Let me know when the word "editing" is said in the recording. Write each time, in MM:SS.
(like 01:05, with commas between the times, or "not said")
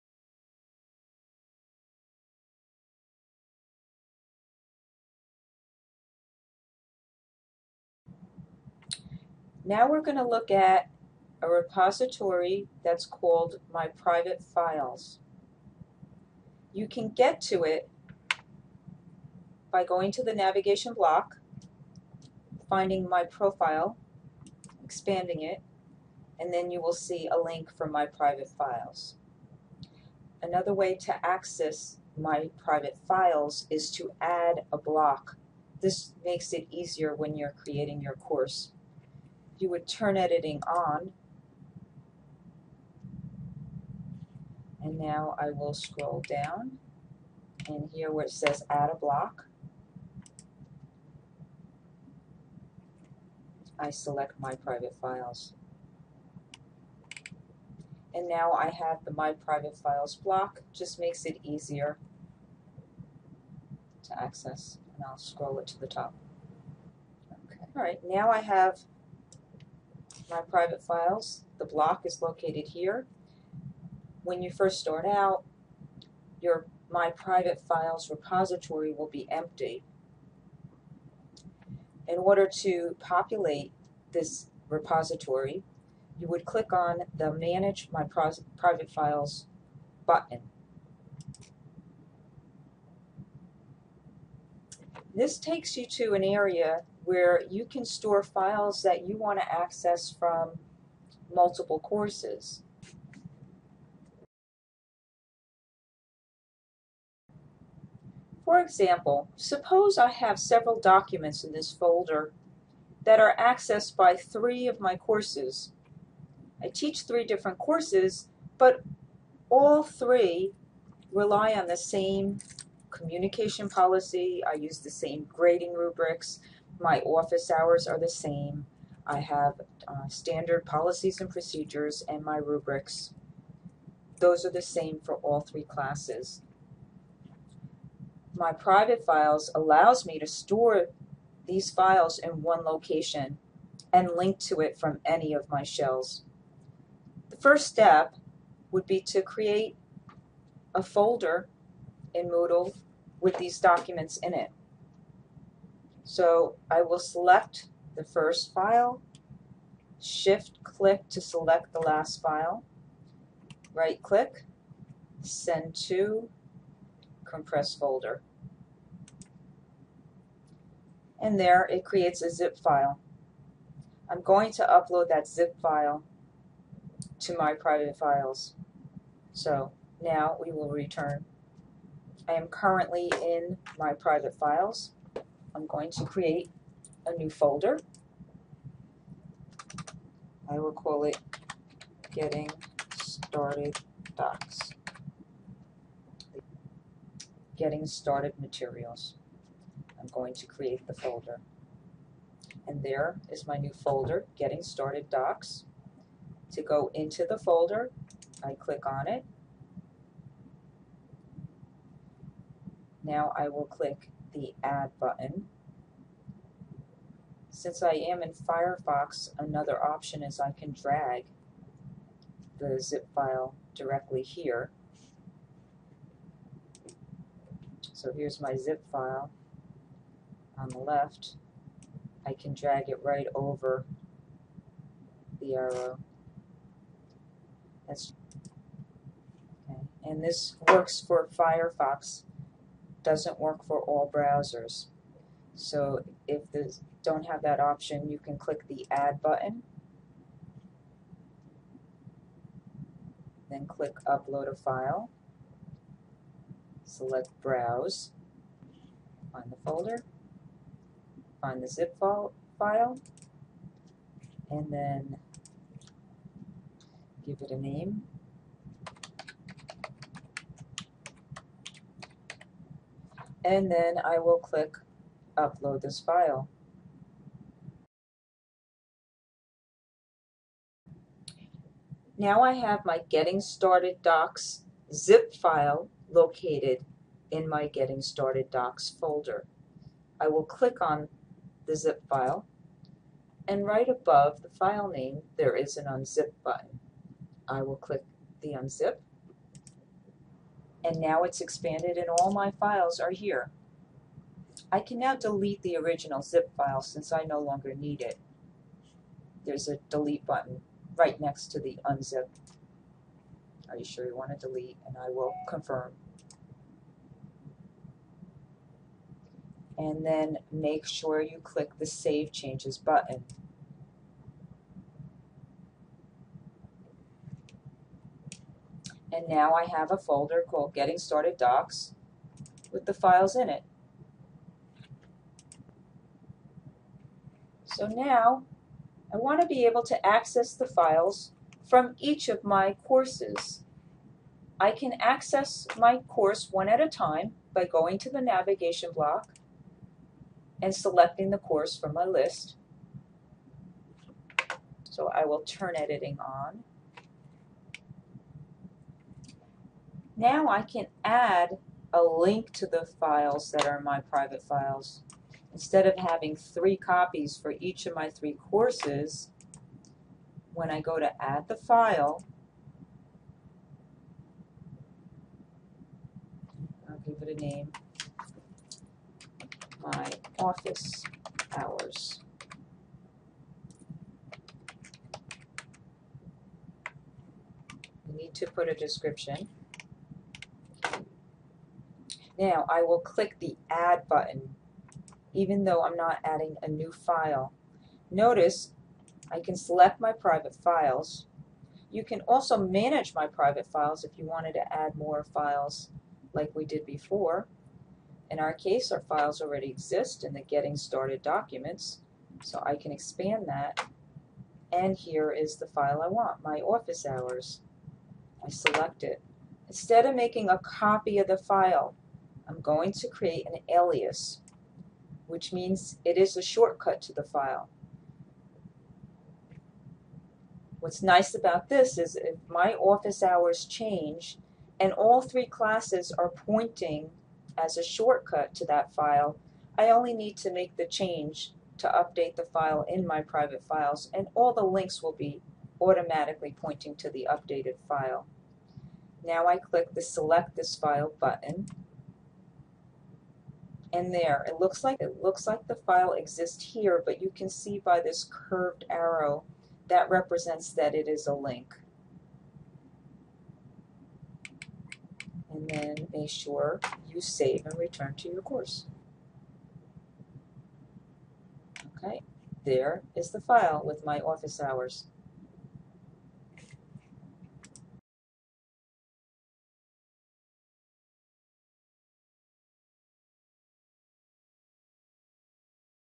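00:40, 05:55.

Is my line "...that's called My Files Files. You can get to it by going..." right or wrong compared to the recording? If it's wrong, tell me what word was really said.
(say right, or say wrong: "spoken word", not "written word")
wrong: "Private", not "Files".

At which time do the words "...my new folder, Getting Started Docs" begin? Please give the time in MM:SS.
03:23.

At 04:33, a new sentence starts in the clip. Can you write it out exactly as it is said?
and then I will click upload this file.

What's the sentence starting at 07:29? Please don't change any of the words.
Now I click the select this file button and there.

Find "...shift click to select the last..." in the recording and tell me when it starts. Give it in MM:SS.
02:39.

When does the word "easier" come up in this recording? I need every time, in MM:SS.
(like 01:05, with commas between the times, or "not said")
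00:36, 01:01.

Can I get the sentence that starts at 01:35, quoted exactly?
This takes you to an area where you can store files that you want to access from multiple courses.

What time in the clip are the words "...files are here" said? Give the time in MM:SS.
05:02.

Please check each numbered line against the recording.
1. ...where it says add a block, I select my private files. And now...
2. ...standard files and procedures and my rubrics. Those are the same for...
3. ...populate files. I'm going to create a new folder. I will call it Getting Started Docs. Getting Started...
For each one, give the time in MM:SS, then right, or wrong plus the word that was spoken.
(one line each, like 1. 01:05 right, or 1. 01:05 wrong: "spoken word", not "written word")
1. 00:48 right
2. 02:10 wrong: "policies", not "files"
3. 03:03 wrong: "private", not "populate".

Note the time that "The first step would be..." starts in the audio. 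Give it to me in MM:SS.
02:27.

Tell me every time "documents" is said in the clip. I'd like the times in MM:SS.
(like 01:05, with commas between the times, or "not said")
01:50, 02:33, 06:51.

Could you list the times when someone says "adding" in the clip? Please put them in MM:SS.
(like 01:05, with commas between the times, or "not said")
06:36.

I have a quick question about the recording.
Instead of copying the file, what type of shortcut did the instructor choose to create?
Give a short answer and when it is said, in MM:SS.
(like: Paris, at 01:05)
an alias, at 07:03.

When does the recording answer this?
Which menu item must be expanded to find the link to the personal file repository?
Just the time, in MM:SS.
00:23.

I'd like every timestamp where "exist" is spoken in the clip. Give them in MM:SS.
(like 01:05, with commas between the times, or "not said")
06:49, 07:36.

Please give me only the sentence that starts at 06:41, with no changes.
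You can also manage my private files if you wanted to add more files like we did before.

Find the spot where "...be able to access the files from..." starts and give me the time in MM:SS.
05:39.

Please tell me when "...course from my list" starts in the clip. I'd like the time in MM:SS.
05:51.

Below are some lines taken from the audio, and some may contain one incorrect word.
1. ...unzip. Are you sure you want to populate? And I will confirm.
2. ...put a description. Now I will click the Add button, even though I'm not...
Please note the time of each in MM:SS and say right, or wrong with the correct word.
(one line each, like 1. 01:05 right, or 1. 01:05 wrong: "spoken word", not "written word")
1. 05:11 wrong: "delete", not "populate"
2. 06:28 right.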